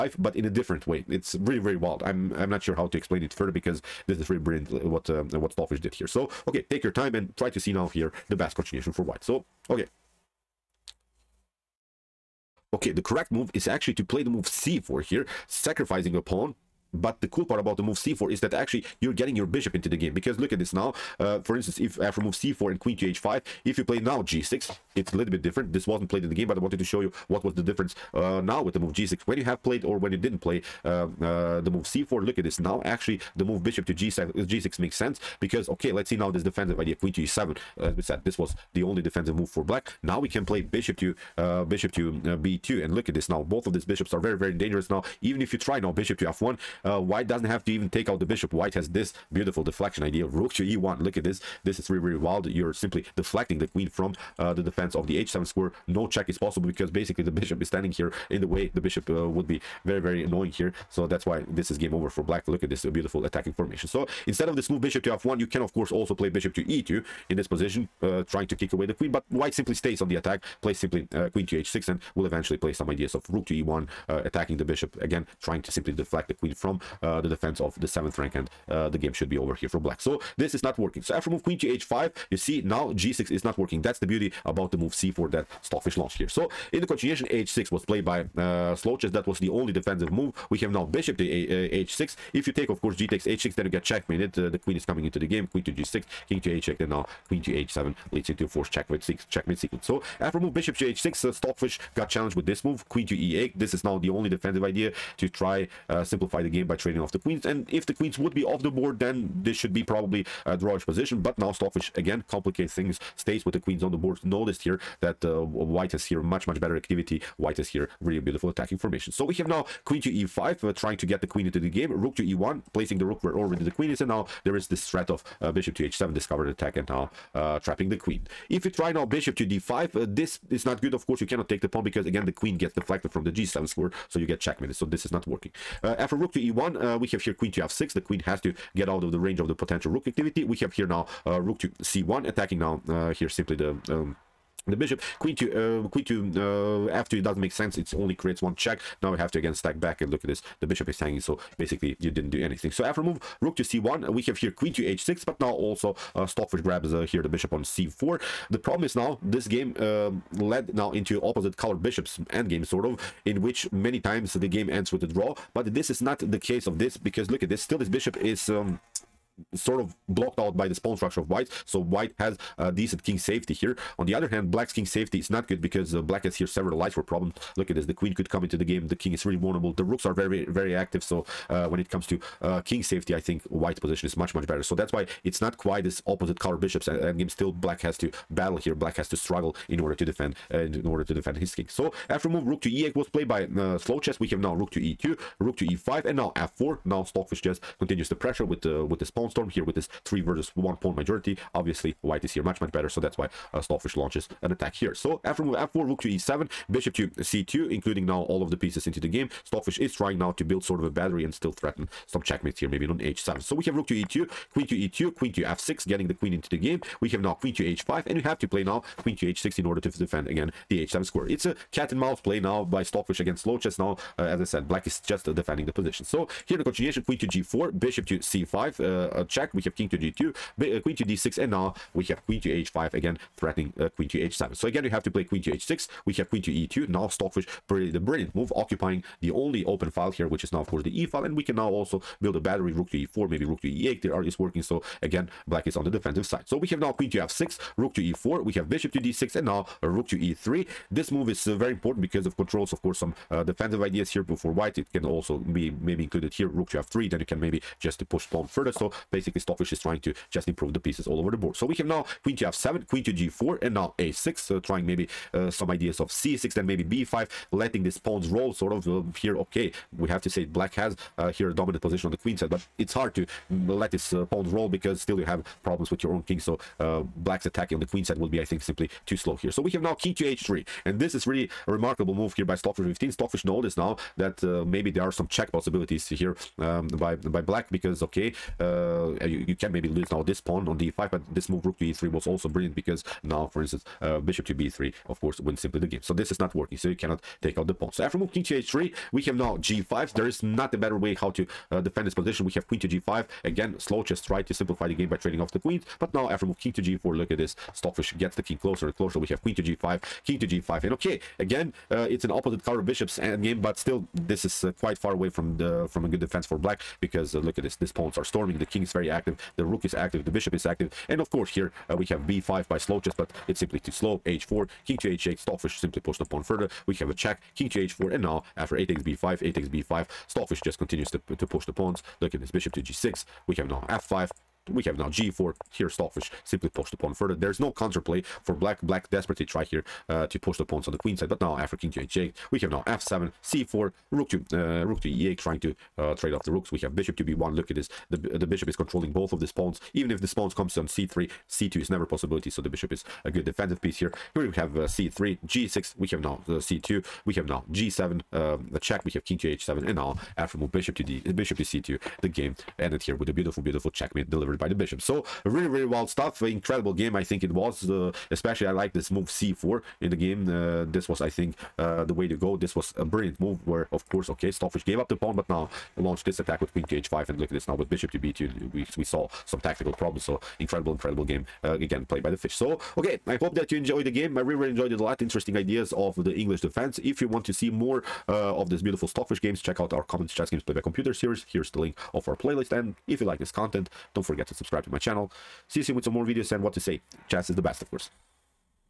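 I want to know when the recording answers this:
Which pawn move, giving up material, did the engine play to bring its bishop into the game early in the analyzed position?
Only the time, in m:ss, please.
0:14.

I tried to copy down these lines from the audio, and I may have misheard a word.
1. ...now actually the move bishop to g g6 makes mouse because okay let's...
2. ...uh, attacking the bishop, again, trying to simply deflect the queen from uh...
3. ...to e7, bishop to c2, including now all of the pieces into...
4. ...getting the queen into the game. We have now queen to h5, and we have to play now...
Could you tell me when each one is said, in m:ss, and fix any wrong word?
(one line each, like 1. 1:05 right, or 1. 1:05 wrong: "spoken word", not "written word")
1. 0:32 wrong: "sense", not "mouse"
2. 1:14 right
3. 3:26 right
4. 3:35 right.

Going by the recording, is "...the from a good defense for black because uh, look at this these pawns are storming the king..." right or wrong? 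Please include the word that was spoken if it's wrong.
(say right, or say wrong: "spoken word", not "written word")
right.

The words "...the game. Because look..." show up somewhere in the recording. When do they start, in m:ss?
0:19.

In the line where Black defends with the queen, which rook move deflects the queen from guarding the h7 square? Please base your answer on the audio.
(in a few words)
Rook to e1.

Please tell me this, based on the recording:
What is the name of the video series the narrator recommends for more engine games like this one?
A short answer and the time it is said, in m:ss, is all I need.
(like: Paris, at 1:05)
Chess Games by Computer, at 6:30.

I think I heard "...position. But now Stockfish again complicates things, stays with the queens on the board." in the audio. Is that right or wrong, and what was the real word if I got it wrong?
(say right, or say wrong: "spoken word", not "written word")
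right.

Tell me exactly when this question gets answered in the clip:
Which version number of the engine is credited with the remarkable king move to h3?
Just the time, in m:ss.
4:42.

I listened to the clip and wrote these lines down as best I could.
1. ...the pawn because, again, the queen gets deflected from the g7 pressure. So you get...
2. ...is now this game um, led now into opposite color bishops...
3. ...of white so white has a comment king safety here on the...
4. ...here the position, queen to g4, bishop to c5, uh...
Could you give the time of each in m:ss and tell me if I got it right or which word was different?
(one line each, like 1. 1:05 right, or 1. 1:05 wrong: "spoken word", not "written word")
1. 2:11 wrong: "square", not "pressure"
2. 2:38 right
3. 2:51 wrong: "decent", not "comment"
4. 3:46 wrong: "continuation", not "position".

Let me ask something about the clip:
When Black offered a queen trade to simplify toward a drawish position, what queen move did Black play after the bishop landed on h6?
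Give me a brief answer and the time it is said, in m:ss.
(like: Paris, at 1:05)
Queen to e8, at 1:42.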